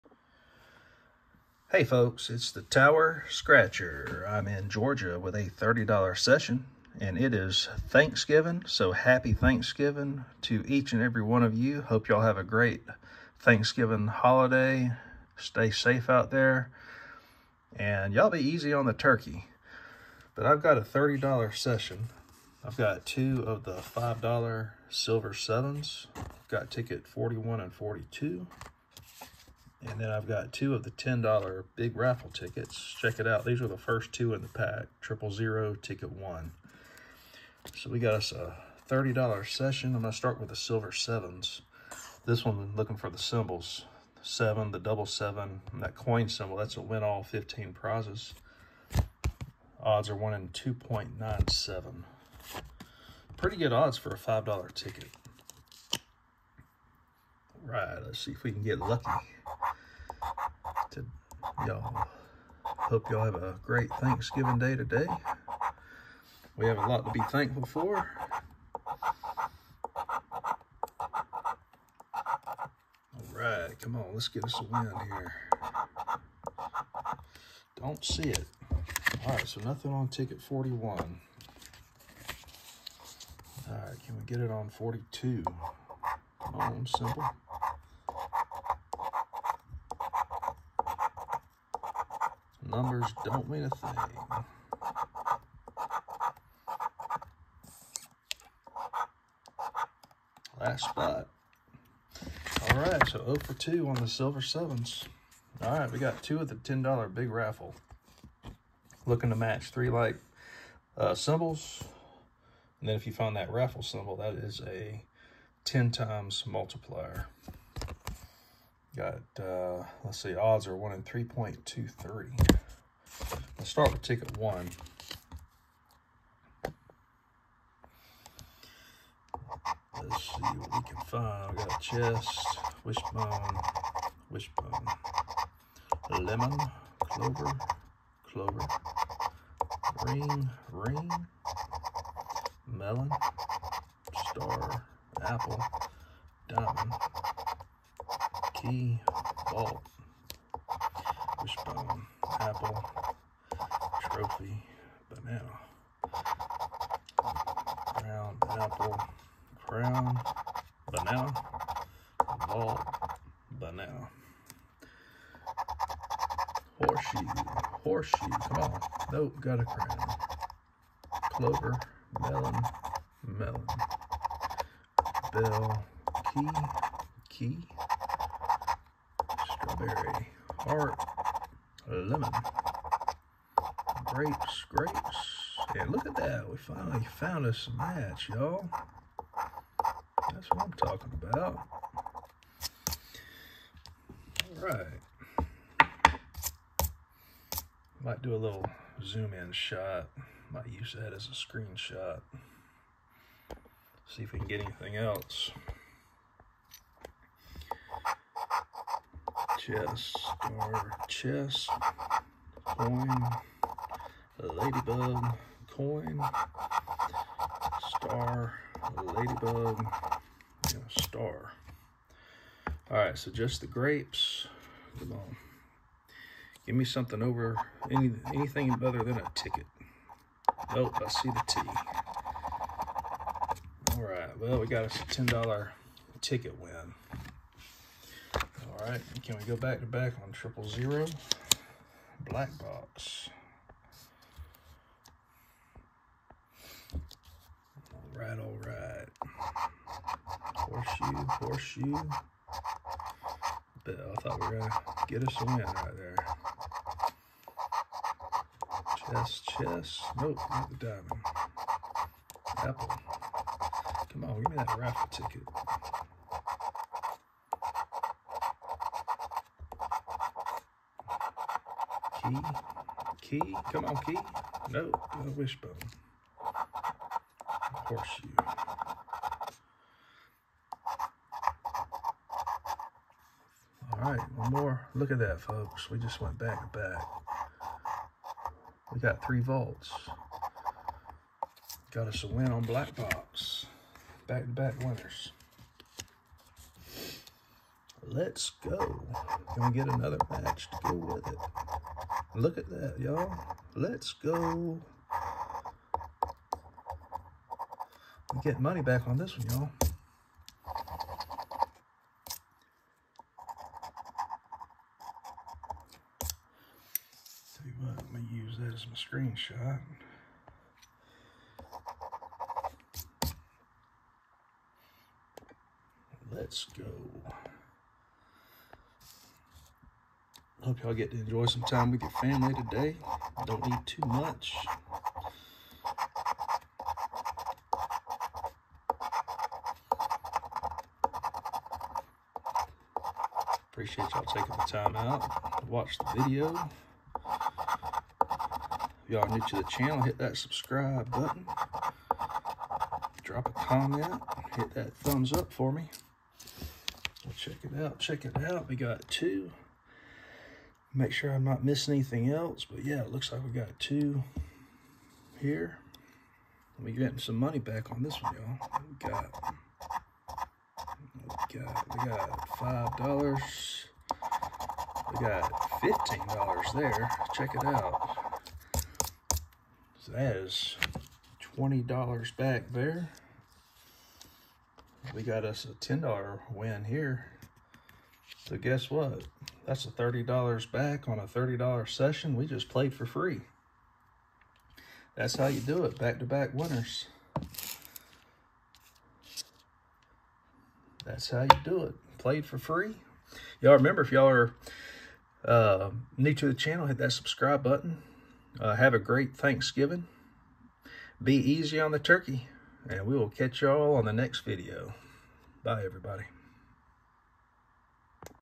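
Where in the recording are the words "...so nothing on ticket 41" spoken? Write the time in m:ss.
1:19.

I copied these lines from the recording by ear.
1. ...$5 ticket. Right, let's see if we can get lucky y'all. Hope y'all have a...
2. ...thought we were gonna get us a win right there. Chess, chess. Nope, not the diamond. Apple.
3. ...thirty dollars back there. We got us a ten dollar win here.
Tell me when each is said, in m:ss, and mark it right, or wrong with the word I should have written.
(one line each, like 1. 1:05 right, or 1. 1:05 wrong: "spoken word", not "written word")
1. 0:54 right
2. 4:14 right
3. 6:21 wrong: "twenty", not "thirty".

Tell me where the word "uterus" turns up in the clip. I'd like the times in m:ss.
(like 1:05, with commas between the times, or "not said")
not said.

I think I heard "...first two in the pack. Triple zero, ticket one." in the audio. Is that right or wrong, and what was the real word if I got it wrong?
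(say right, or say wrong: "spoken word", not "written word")
right.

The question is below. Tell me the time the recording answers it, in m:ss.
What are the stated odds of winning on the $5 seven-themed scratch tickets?
0:50.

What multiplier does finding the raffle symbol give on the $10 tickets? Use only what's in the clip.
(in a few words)
10 times.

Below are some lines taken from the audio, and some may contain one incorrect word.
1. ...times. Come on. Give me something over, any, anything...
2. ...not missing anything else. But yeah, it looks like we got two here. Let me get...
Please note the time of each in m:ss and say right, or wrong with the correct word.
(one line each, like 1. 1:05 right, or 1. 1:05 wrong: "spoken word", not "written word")
1. 3:43 wrong: "grapes", not "times"
2. 6:01 right.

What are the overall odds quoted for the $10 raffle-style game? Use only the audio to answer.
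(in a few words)
1 in 3.23.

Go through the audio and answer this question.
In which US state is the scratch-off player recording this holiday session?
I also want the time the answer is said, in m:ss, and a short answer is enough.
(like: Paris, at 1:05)
Georgia, at 0:04.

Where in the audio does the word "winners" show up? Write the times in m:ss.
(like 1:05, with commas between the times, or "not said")
4:54, 6:36.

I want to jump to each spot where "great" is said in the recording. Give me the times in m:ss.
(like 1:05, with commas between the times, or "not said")
0:12, 1:03, 6:48.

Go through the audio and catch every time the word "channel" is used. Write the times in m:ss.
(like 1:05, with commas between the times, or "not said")
5:49, 6:46.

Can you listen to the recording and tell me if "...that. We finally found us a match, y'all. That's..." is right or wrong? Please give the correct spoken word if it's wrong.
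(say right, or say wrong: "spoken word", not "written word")
right.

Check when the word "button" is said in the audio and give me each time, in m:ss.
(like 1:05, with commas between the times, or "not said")
5:51, 6:47.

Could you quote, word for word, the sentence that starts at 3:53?
All right, well, we got us a $10 ticket win.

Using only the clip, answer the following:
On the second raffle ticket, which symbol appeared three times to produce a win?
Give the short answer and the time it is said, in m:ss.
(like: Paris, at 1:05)
vaults, at 4:49.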